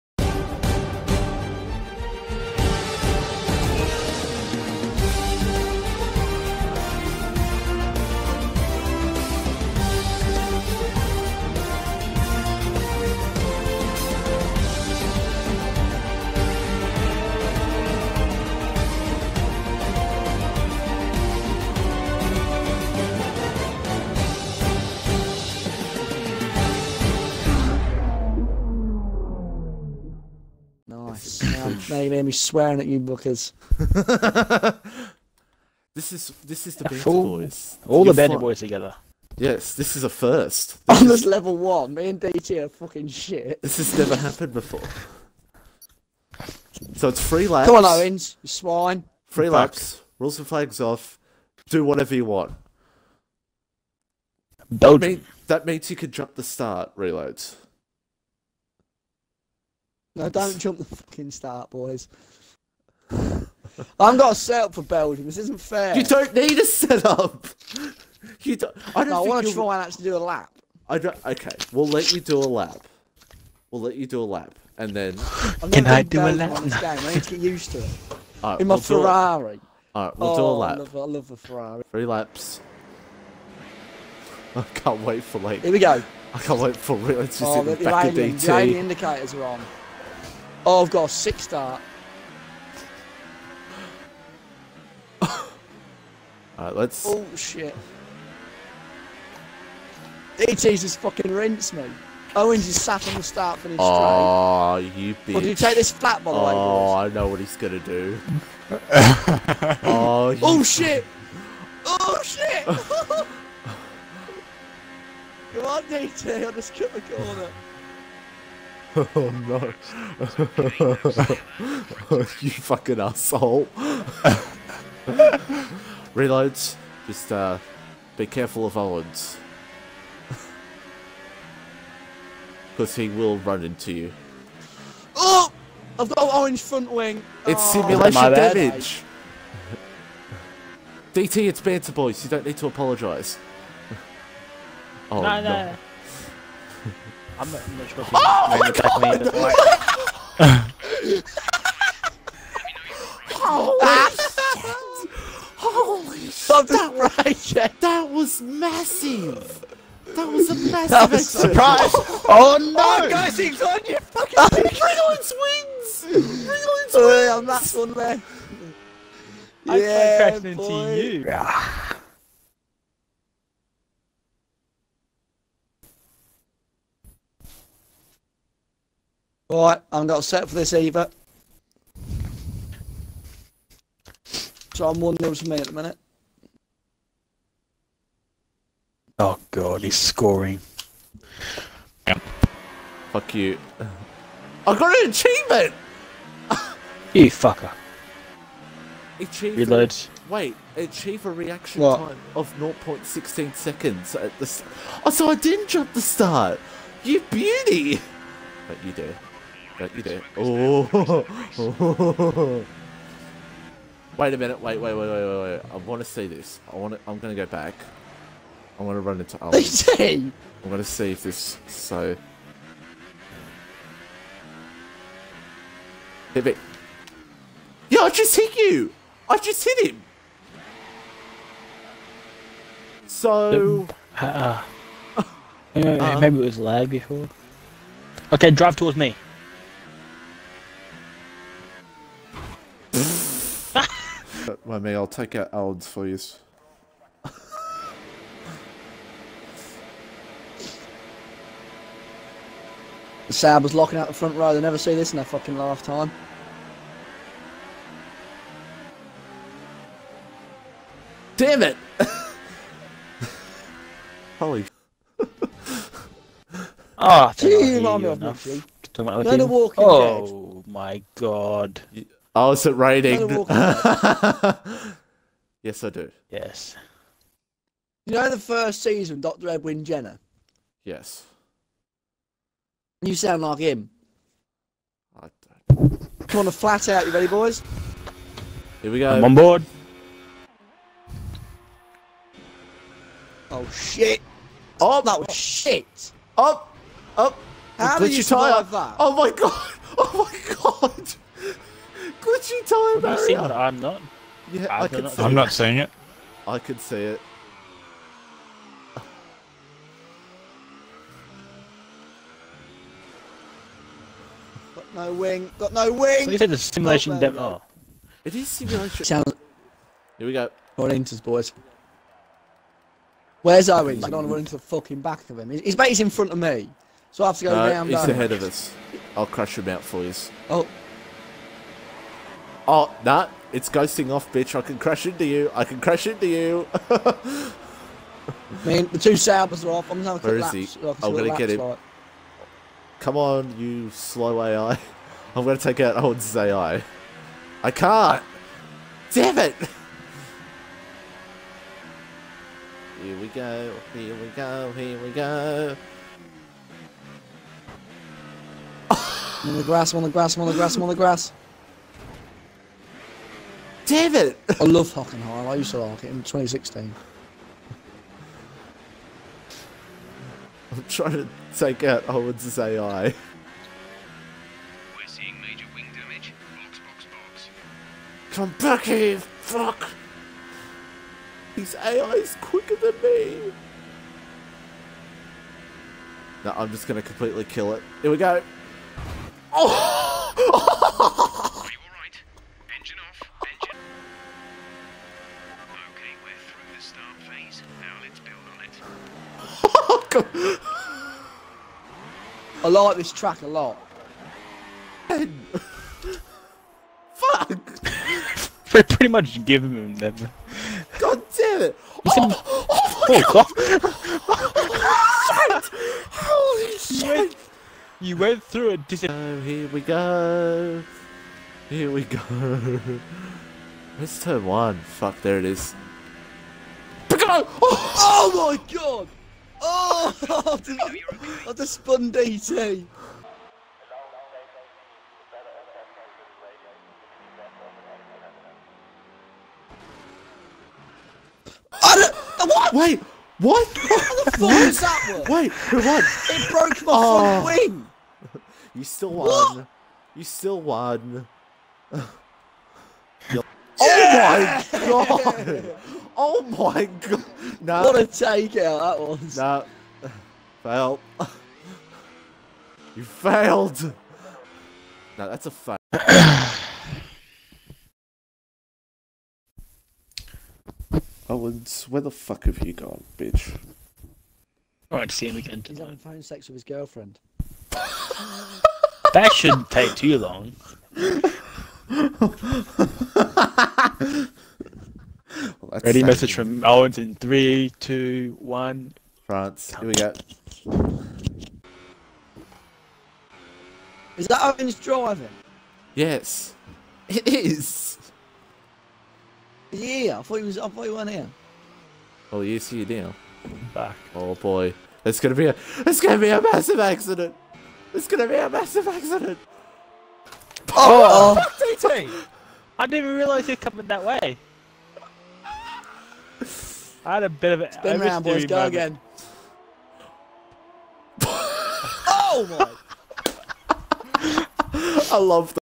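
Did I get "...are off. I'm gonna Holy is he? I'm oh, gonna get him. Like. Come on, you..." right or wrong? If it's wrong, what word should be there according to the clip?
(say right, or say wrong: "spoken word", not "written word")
wrong: "Where", not "Holy".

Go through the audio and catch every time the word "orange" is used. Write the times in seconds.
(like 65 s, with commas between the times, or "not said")
136 s.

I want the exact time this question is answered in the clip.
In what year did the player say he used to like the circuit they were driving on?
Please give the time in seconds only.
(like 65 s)
366 s.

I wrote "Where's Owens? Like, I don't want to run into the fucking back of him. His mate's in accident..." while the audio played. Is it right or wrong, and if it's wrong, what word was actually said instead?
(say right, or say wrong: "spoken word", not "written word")
wrong: "front", not "accident".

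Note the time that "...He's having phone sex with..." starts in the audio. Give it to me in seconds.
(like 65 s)
475 s.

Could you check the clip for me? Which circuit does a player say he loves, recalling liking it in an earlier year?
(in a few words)
Hockenheim.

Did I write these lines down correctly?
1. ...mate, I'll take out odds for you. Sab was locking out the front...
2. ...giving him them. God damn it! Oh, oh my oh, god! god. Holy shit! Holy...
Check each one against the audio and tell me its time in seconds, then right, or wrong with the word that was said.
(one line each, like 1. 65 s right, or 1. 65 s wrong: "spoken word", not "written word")
1. 244 s right
2. 409 s right.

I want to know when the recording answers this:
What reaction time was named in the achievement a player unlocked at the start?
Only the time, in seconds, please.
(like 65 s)
202 s.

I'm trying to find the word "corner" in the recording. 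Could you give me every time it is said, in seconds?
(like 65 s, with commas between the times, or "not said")
117 s.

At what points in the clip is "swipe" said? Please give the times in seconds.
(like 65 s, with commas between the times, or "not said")
not said.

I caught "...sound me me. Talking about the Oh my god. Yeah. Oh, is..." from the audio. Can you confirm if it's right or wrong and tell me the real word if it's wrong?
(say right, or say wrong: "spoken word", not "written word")
wrong: "remind", not "sound".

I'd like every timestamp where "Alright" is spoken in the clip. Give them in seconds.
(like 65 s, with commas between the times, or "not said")
96 s, 474 s.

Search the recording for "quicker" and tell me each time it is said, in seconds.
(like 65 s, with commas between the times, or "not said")
382 s.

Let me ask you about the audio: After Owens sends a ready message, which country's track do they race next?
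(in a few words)
France.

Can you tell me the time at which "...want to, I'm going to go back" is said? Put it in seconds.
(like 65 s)
216 s.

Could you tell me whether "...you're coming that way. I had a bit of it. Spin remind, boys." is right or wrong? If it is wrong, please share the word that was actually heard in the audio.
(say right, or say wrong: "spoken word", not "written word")
wrong: "round", not "remind".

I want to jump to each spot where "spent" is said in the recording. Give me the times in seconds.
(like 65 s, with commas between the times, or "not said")
not said.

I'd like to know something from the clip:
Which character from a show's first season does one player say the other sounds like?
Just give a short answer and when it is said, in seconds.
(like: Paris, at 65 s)
Dr. Edwin Jenner, at 279 s.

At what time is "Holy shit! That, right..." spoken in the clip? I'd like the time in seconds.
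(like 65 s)
155 s.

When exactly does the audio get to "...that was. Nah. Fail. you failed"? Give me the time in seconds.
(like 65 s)
458 s.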